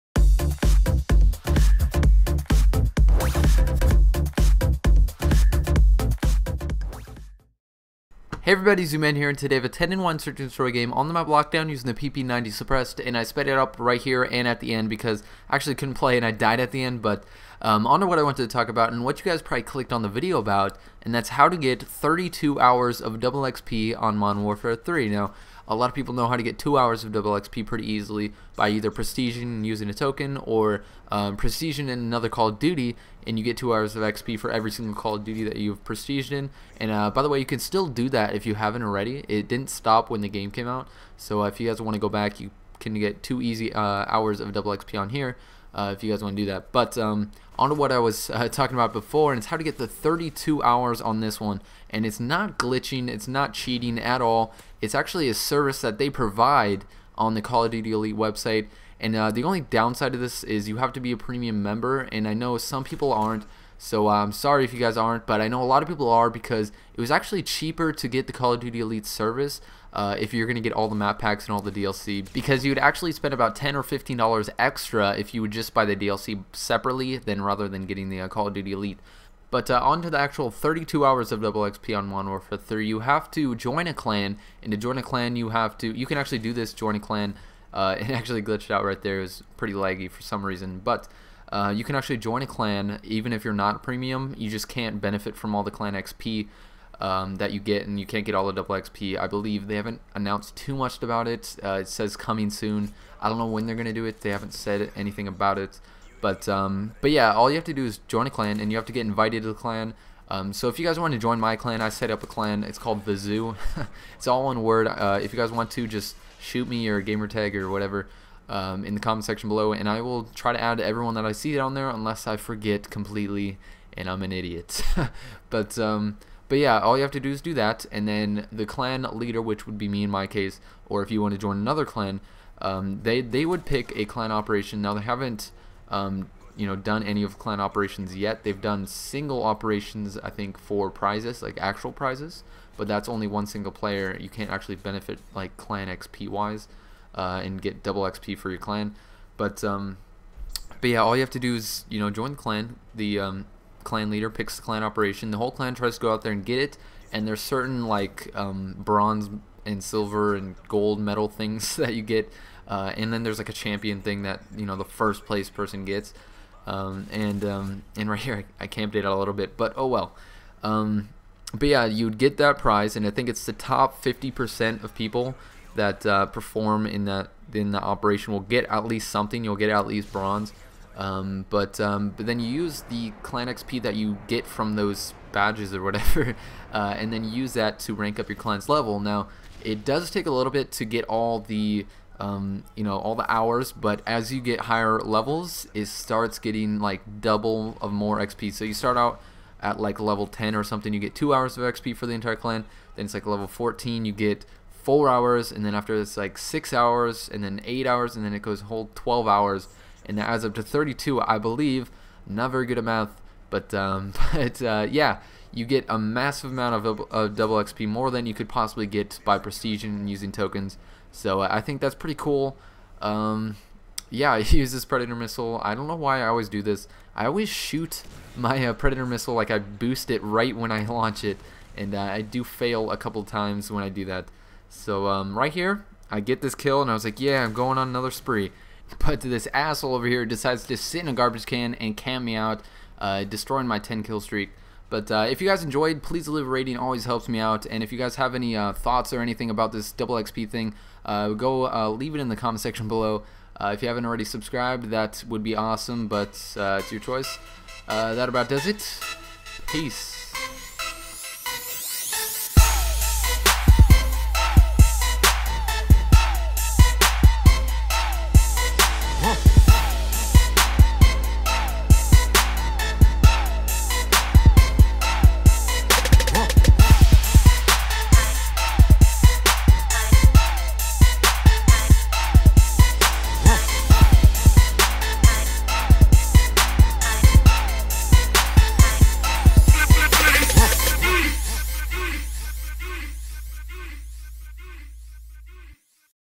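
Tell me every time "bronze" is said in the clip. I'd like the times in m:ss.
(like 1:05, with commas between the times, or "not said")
2:38, 3:00.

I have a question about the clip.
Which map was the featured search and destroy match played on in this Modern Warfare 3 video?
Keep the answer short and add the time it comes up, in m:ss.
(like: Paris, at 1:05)
Lockdown, at 0:11.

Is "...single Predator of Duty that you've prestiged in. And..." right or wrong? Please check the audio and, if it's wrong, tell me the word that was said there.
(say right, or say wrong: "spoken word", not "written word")
wrong: "Call", not "Predator".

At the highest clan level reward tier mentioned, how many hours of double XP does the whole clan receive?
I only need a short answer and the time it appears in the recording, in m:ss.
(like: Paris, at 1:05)
12 hours, at 3:28.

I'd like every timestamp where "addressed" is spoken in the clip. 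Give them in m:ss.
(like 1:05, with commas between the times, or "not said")
not said.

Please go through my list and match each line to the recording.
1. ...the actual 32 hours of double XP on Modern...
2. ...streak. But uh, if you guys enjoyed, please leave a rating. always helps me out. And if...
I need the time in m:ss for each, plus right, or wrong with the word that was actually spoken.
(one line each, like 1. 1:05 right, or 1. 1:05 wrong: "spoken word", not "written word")
1. 1:20 right
2. 4:04 right.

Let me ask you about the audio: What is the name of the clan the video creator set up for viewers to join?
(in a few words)
The Zoo.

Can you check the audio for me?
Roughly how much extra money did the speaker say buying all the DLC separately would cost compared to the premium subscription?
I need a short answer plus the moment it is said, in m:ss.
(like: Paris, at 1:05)
$10 or $15, at 1:13.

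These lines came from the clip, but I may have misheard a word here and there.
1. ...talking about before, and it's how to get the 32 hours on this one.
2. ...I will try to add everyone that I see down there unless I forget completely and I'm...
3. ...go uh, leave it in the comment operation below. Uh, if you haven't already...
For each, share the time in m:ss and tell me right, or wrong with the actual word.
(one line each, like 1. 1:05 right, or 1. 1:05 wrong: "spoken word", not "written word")
1. 0:48 right
2. 1:59 right
3. 4:11 wrong: "section", not "operation".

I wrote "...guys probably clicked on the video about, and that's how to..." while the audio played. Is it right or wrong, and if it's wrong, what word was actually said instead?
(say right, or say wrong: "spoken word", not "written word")
right.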